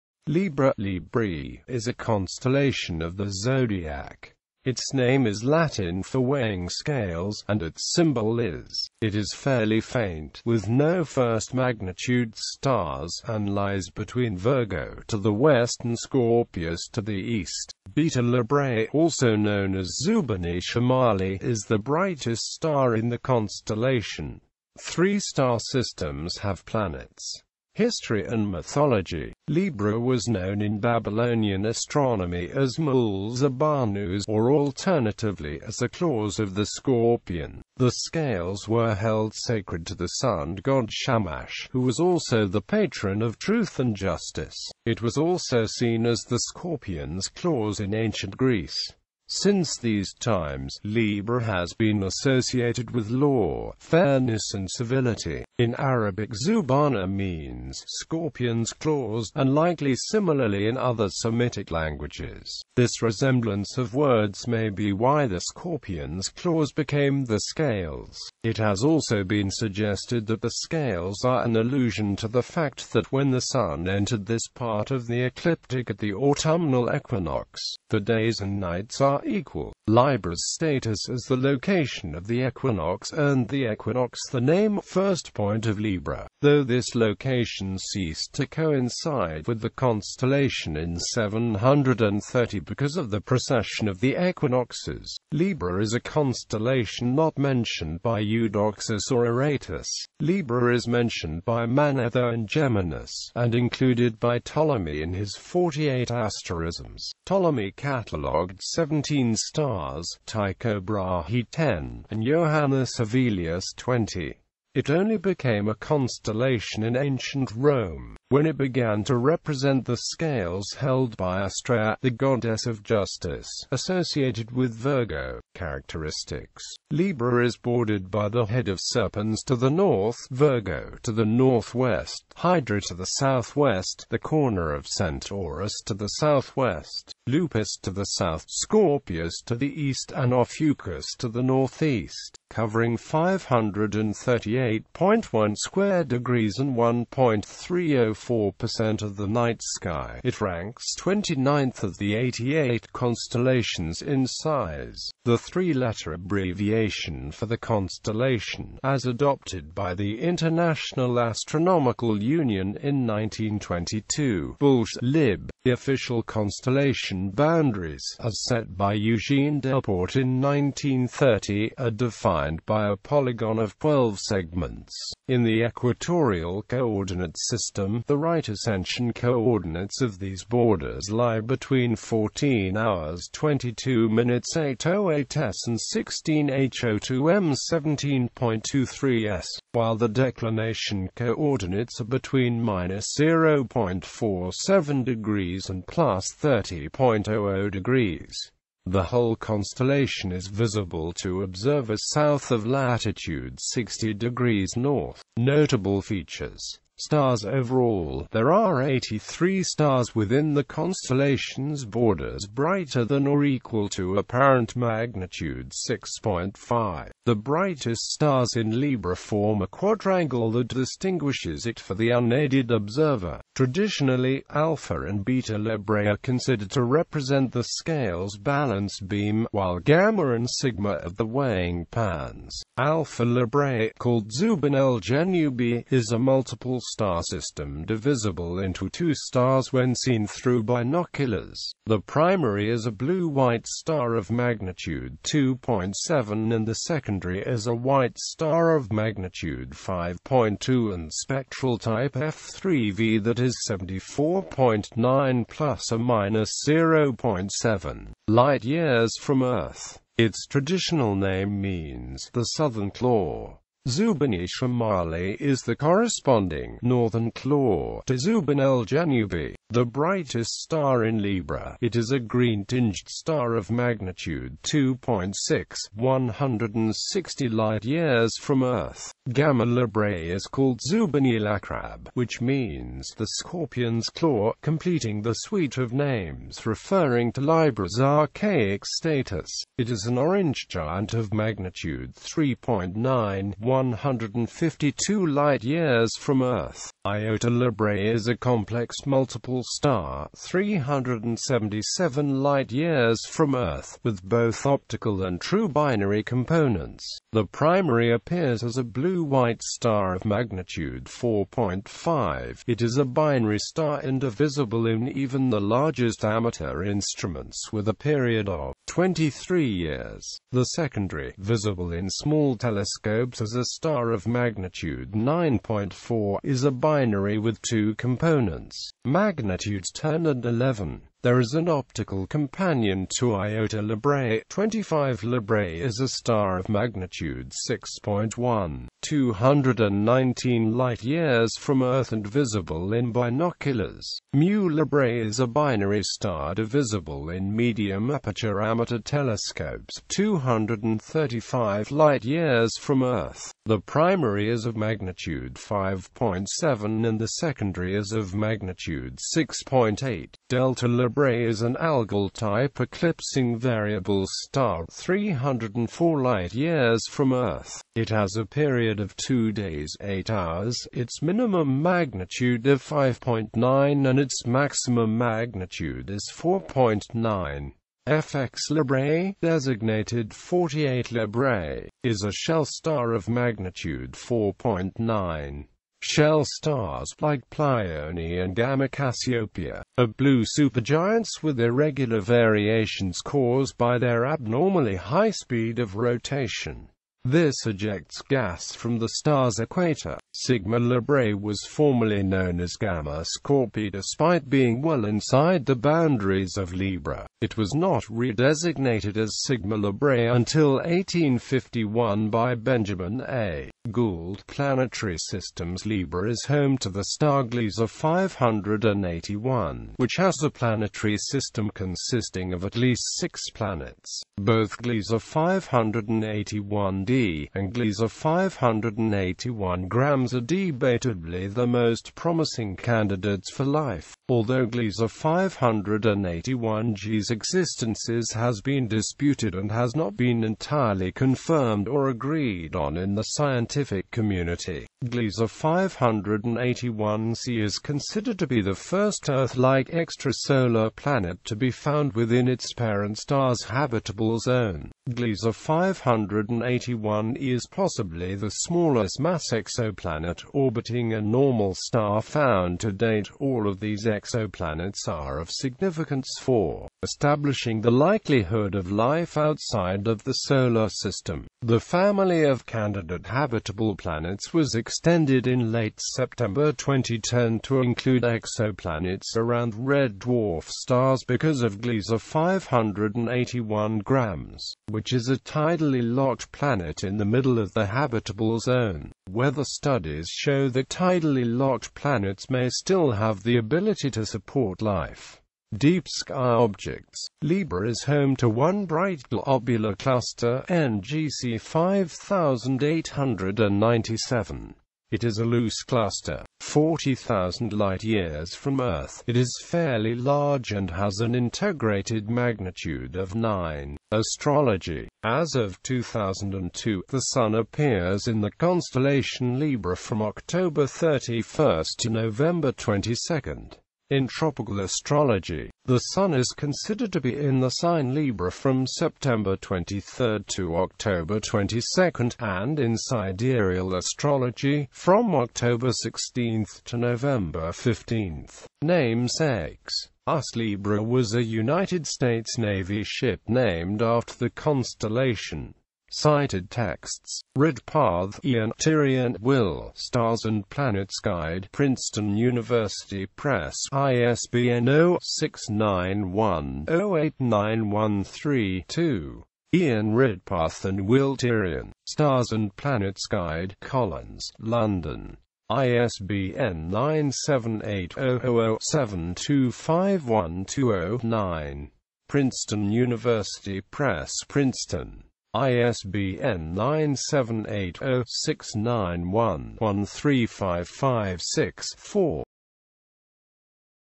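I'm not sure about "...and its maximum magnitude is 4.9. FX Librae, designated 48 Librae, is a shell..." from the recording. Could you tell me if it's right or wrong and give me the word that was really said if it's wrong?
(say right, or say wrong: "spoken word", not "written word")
right.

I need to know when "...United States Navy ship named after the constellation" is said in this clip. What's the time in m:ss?
9:01.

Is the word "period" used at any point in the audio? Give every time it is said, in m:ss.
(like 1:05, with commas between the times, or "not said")
5:17, 6:08.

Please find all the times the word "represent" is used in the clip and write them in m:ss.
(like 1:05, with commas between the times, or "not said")
1:59, 3:46.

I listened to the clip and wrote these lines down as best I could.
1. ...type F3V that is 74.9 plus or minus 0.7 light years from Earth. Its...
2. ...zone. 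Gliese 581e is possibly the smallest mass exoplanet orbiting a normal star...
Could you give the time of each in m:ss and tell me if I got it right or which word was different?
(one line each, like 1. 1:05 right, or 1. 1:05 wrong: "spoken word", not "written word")
1. 4:11 right
2. 7:34 right.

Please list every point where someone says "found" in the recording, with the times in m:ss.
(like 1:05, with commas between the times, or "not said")
7:31, 7:42.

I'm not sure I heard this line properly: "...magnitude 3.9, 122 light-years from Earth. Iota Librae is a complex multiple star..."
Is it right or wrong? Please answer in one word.
wrong.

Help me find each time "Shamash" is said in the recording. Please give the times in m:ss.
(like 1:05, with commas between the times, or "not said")
0:40.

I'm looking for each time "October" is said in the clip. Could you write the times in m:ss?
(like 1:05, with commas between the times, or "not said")
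8:40, 8:50, 8:55.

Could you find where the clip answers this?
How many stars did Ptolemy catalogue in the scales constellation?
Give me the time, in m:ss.
1:48.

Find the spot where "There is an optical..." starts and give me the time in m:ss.
5:31.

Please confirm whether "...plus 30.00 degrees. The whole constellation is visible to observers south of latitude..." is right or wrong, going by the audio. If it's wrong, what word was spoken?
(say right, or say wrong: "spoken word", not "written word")
right.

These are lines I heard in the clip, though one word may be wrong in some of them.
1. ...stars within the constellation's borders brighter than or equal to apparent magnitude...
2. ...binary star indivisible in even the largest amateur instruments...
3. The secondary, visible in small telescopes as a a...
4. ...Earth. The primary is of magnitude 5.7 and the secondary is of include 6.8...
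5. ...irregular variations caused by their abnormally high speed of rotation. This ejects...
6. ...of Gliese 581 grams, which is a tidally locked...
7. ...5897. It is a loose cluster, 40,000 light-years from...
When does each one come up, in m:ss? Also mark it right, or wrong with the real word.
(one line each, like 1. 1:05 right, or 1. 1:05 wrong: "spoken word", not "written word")
1. 3:29 right
2. 5:13 right
3. 5:20 right
4. 5:53 wrong: "magnitude", not "include"
5. 6:31 right
6. 8:01 right
7. 8:21 right.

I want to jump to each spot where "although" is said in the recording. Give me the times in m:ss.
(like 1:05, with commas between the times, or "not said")
7:14.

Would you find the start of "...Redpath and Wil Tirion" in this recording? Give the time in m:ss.
9:20.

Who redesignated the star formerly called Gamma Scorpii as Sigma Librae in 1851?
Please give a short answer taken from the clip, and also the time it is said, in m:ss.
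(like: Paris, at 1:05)
Benjamin A. Gould, at 6:52.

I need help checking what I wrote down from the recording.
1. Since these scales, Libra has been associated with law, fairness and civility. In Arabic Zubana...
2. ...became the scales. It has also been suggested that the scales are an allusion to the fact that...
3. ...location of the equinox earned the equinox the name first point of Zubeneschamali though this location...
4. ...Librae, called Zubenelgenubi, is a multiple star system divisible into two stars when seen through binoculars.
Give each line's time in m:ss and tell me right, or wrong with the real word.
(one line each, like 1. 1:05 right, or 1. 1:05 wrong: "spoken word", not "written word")
1. 0:49 wrong: "times", not "scales"
2. 1:06 right
3. 1:21 wrong: "Libra", not "Zubeneschamali"
4. 3:53 right.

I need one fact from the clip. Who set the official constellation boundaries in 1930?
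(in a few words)
Eugene Delporte.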